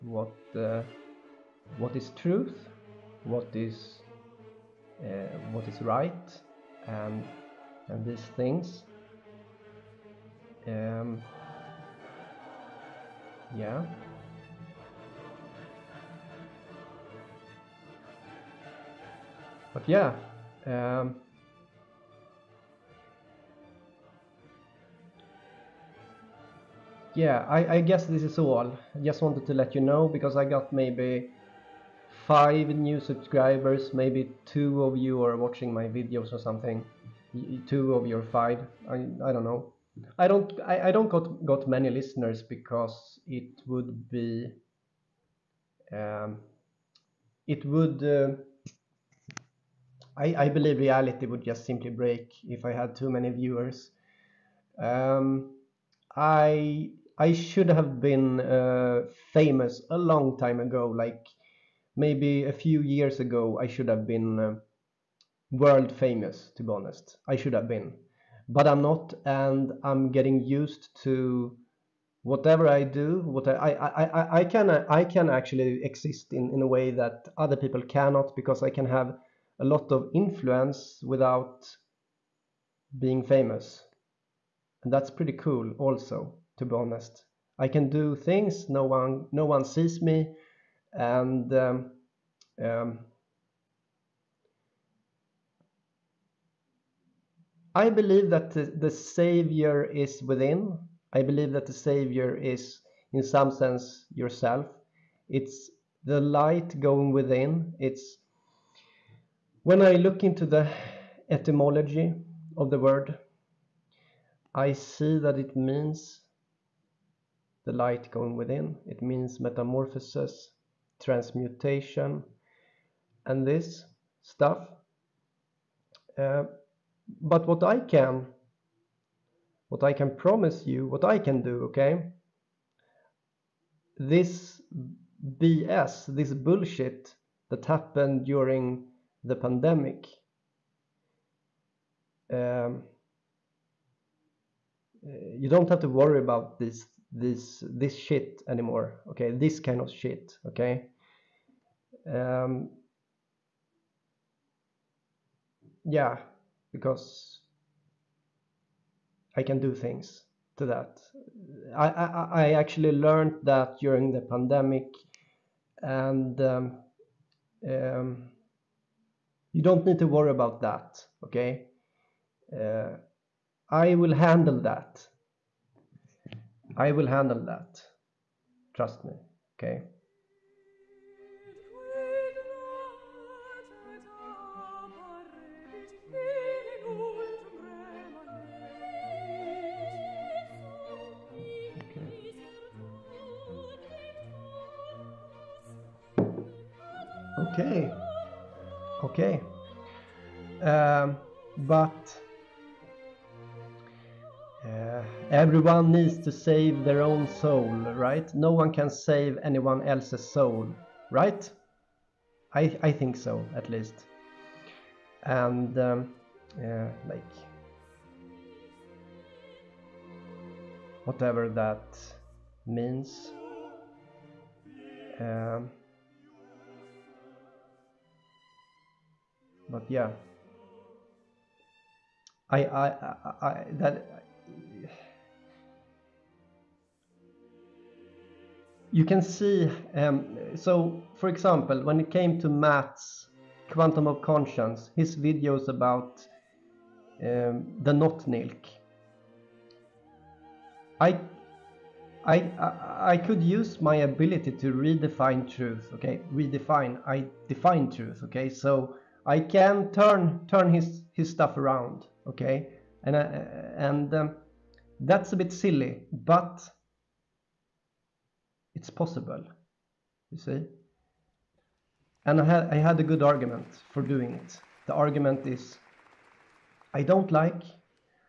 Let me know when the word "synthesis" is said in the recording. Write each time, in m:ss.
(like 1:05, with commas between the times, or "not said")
not said.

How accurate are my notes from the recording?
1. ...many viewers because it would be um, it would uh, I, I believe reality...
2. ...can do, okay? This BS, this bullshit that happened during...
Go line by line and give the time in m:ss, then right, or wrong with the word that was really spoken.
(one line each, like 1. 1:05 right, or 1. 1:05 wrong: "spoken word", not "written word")
1. 0:41 wrong: "listeners", not "viewers"
2. 2:11 right.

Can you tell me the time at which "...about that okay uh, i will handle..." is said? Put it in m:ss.
2:50.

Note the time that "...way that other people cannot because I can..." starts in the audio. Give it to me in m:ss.
1:16.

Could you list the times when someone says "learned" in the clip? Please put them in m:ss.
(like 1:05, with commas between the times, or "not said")
2:42.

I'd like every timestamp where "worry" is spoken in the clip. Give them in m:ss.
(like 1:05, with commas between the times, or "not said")
2:25, 2:50.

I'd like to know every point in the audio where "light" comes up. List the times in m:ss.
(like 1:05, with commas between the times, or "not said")
1:46, 1:57.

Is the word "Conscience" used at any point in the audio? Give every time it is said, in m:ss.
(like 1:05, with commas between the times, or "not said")
4:04.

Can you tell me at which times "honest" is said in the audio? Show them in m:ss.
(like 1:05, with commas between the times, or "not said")
1:06, 1:26.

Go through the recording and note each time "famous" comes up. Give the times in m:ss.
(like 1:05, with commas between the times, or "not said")
0:59, 1:05, 1:23.